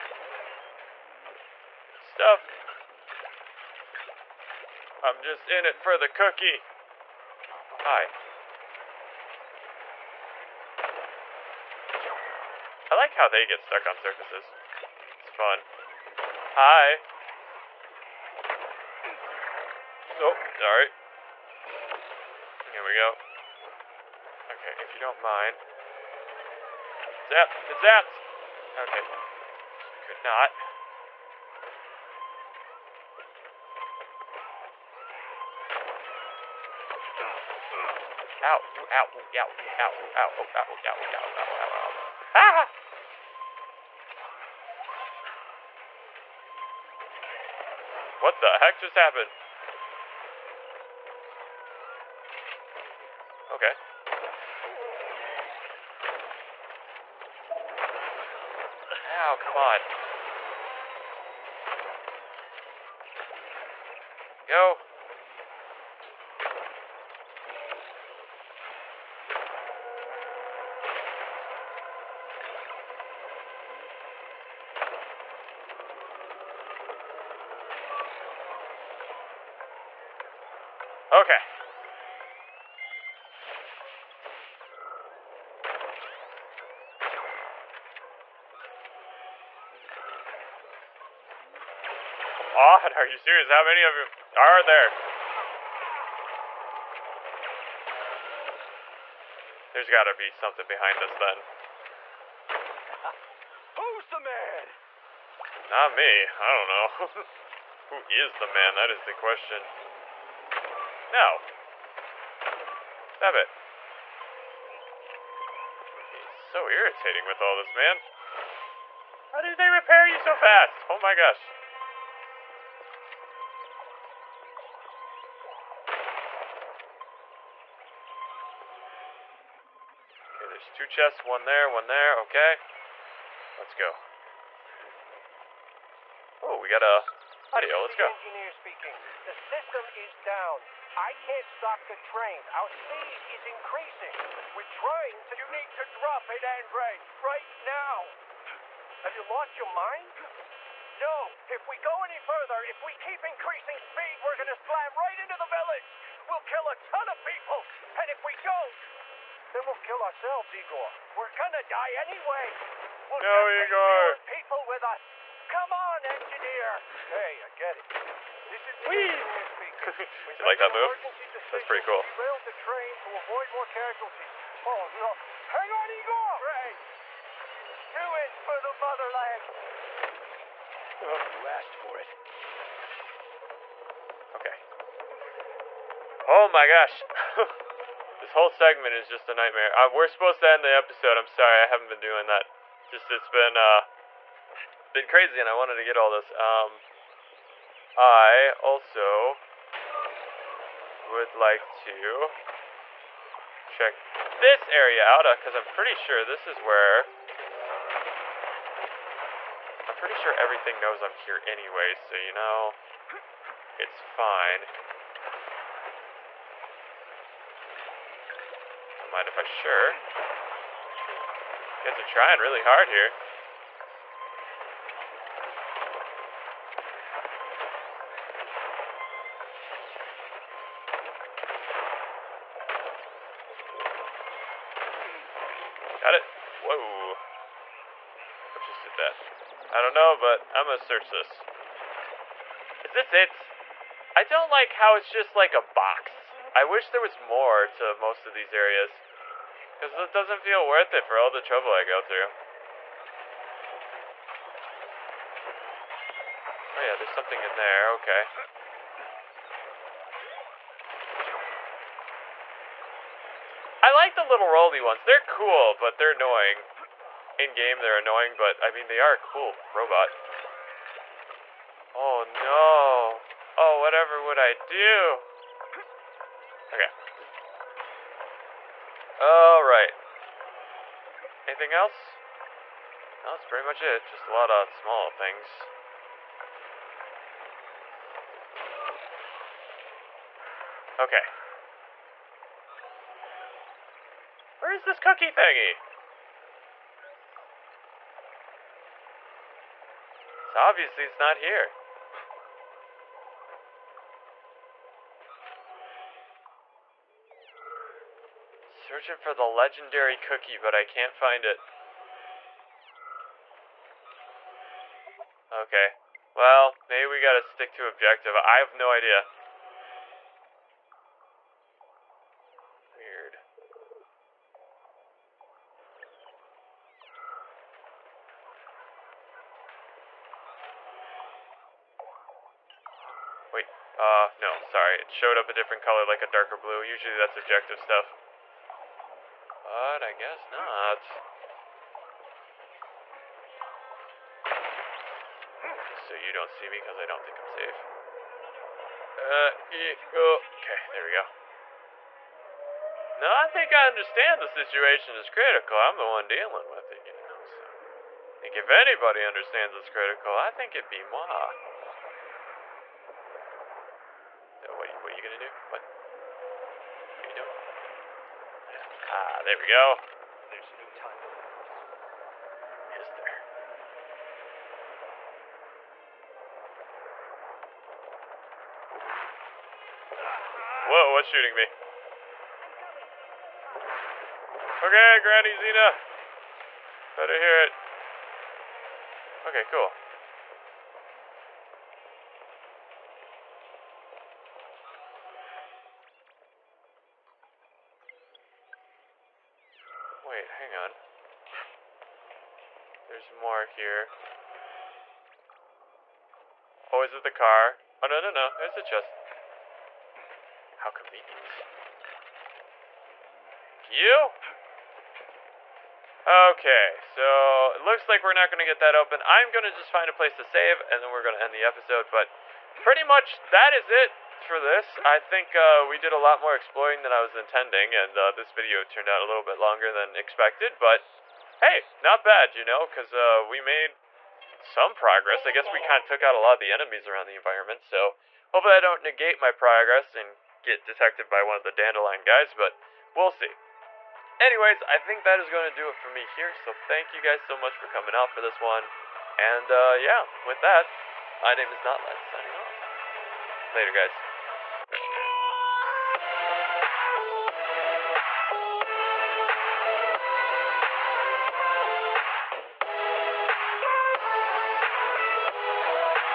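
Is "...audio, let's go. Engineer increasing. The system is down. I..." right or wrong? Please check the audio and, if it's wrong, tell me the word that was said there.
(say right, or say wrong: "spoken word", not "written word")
wrong: "speaking", not "increasing".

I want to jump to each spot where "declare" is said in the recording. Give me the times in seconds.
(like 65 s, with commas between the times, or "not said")
not said.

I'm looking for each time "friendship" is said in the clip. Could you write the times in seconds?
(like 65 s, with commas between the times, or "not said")
not said.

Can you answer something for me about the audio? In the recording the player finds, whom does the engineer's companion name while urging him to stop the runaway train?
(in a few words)
Andre.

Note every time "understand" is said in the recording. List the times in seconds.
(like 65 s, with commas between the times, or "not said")
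353 s, 359 s.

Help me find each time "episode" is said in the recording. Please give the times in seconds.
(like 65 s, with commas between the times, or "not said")
190 s, 421 s.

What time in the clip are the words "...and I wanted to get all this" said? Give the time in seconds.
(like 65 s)
195 s.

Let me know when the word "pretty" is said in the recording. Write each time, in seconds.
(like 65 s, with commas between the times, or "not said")
171 s, 205 s, 209 s, 283 s, 422 s.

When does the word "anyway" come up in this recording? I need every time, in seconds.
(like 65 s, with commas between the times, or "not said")
161 s, 211 s, 444 s.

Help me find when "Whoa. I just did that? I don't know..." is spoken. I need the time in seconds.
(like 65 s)
236 s.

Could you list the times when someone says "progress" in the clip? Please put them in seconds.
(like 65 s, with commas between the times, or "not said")
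434 s, 439 s.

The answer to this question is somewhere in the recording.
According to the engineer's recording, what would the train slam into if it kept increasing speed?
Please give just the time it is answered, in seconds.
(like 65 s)
155 s.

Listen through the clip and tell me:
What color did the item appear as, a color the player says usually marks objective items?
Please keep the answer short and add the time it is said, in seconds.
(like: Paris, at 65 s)
darker blue, at 336 s.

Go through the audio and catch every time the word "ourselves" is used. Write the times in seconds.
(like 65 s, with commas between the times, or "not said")
160 s.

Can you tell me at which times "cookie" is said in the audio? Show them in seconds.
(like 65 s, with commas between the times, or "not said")
6 s, 294 s, 310 s.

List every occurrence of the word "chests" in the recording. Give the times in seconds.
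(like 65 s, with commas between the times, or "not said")
130 s, 408 s.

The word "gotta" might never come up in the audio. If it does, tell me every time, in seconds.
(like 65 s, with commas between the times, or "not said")
99 s, 317 s.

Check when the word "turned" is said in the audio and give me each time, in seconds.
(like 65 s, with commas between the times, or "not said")
428 s.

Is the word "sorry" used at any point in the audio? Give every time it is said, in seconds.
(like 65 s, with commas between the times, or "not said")
191 s, 334 s.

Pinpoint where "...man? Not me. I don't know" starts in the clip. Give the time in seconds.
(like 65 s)
104 s.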